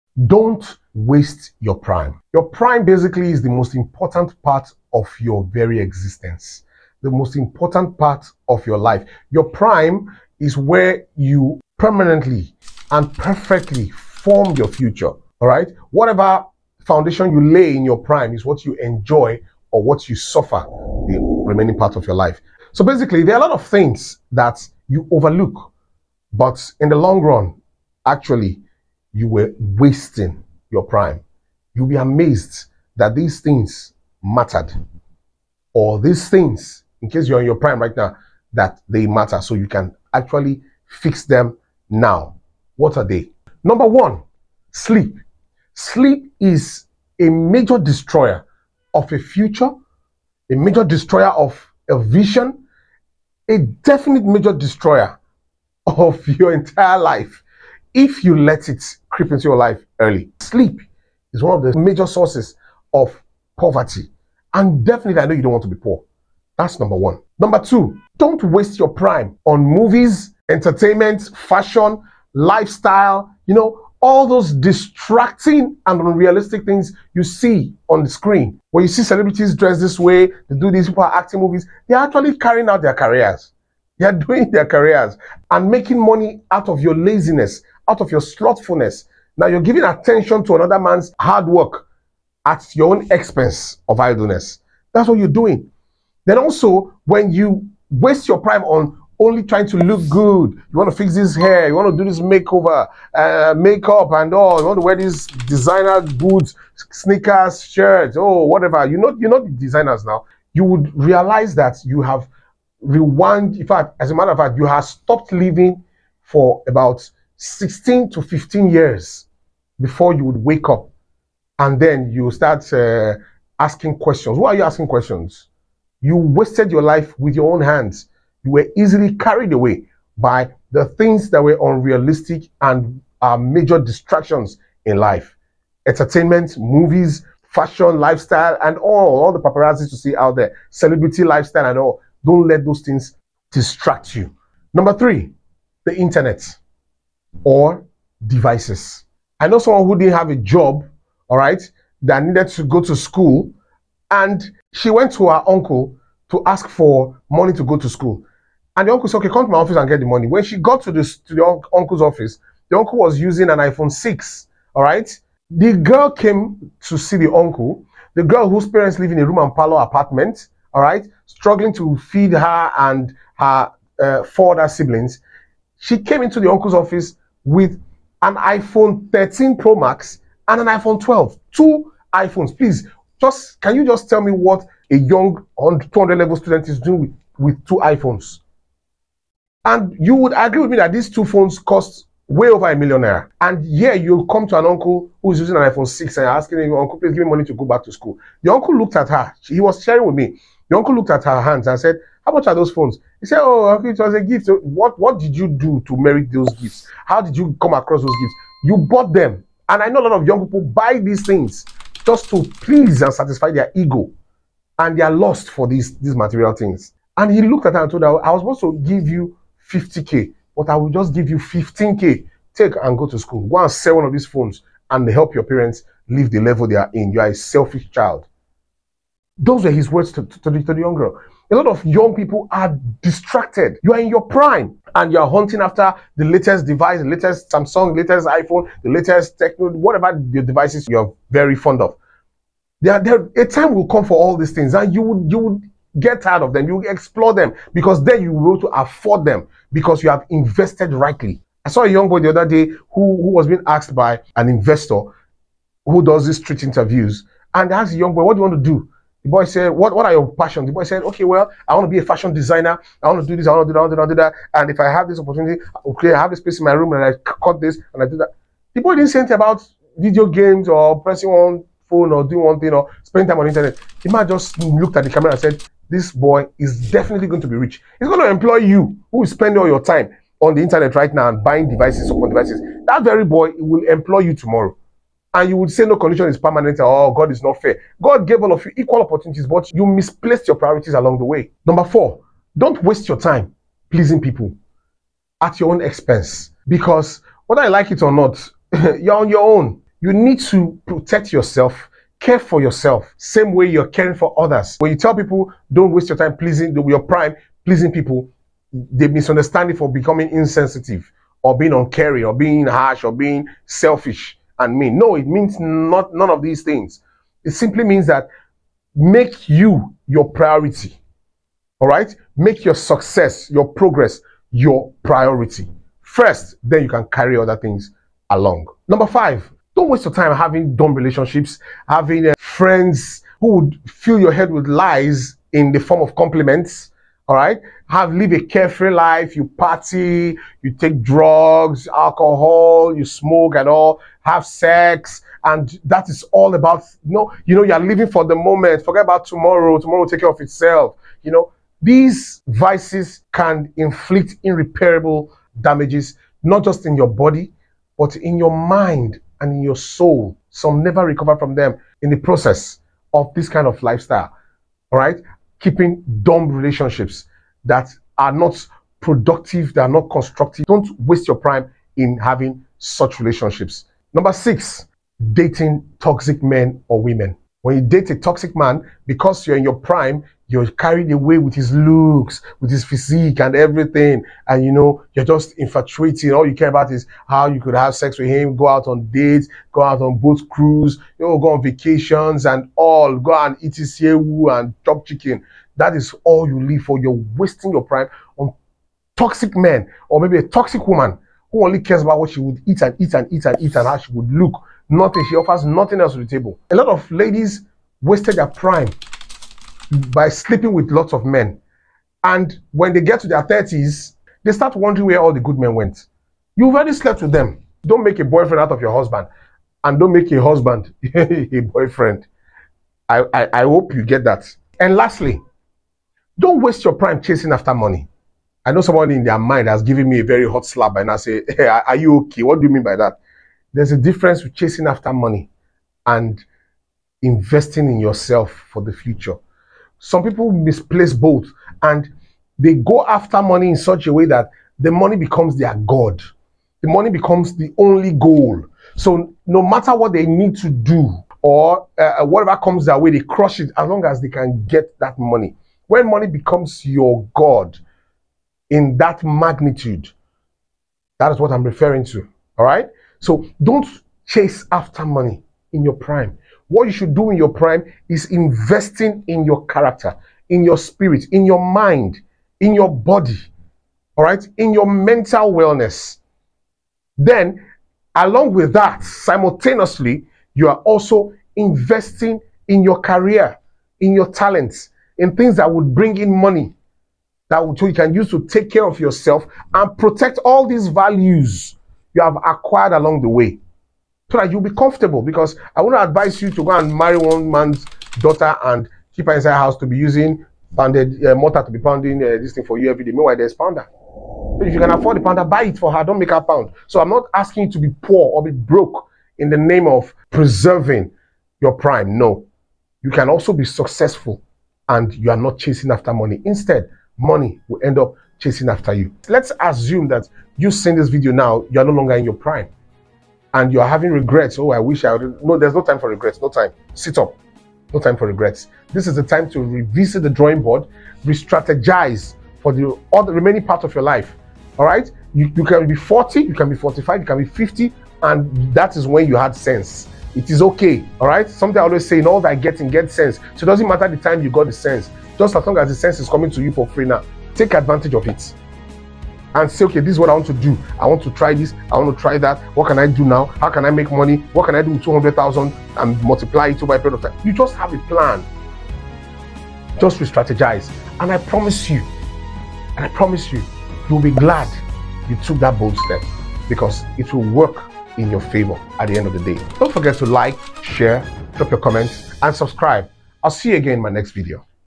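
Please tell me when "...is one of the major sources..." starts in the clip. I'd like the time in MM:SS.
01:01.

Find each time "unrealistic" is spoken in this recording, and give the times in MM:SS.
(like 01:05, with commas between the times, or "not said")
01:16, 02:11.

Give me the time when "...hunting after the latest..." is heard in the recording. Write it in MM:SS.
03:55.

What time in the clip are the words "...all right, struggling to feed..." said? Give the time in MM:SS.
02:50.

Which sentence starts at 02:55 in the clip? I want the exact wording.
She came into the uncle's office with an iPhone 13 Pro Max and an iPhone 12.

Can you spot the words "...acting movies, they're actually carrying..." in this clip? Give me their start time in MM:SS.
01:21.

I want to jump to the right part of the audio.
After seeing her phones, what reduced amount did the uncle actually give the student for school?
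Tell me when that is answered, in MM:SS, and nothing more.
03:41.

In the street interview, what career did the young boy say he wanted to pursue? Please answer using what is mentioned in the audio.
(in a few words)
Fashion designer.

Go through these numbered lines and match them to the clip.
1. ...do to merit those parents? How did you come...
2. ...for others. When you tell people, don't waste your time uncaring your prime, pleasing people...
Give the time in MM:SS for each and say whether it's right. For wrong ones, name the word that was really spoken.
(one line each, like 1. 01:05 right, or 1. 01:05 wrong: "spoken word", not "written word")
1. 03:25 wrong: "gifts", not "parents"
2. 05:04 wrong: "pleasing", not "uncaring".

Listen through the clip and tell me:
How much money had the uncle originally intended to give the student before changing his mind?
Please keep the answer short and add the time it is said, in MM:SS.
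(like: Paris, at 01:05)
50K, at 03:39.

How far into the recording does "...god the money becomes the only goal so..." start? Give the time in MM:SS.
07:25.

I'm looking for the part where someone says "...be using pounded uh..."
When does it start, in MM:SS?
08:19.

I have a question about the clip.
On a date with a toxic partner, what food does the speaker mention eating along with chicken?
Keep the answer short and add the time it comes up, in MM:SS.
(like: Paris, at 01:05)
Sewu, at 06:33.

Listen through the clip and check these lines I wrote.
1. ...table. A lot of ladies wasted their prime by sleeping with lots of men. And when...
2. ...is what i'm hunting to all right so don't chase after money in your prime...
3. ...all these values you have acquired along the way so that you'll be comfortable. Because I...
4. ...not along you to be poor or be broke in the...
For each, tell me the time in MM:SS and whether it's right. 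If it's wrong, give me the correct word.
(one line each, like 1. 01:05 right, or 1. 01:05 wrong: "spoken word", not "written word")
1. 06:46 right
2. 07:41 wrong: "referring", not "hunting"
3. 08:10 right
4. 08:27 wrong: "asking", not "along".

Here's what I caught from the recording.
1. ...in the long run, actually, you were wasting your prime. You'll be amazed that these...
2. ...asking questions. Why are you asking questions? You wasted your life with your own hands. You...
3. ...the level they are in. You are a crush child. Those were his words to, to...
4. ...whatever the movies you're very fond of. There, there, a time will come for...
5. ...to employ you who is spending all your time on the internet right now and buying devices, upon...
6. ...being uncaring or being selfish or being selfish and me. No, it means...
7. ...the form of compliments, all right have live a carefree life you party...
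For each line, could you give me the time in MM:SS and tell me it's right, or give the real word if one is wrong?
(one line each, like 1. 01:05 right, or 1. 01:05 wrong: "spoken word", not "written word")
1. 00:26 right
2. 02:03 right
3. 03:46 wrong: "selfish", not "crush"
4. 03:59 wrong: "devices", not "movies"
5. 04:38 right
6. 05:11 wrong: "harsh", not "selfish"
7. 05:35 right.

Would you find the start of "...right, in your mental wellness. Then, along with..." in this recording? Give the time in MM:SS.
07:54.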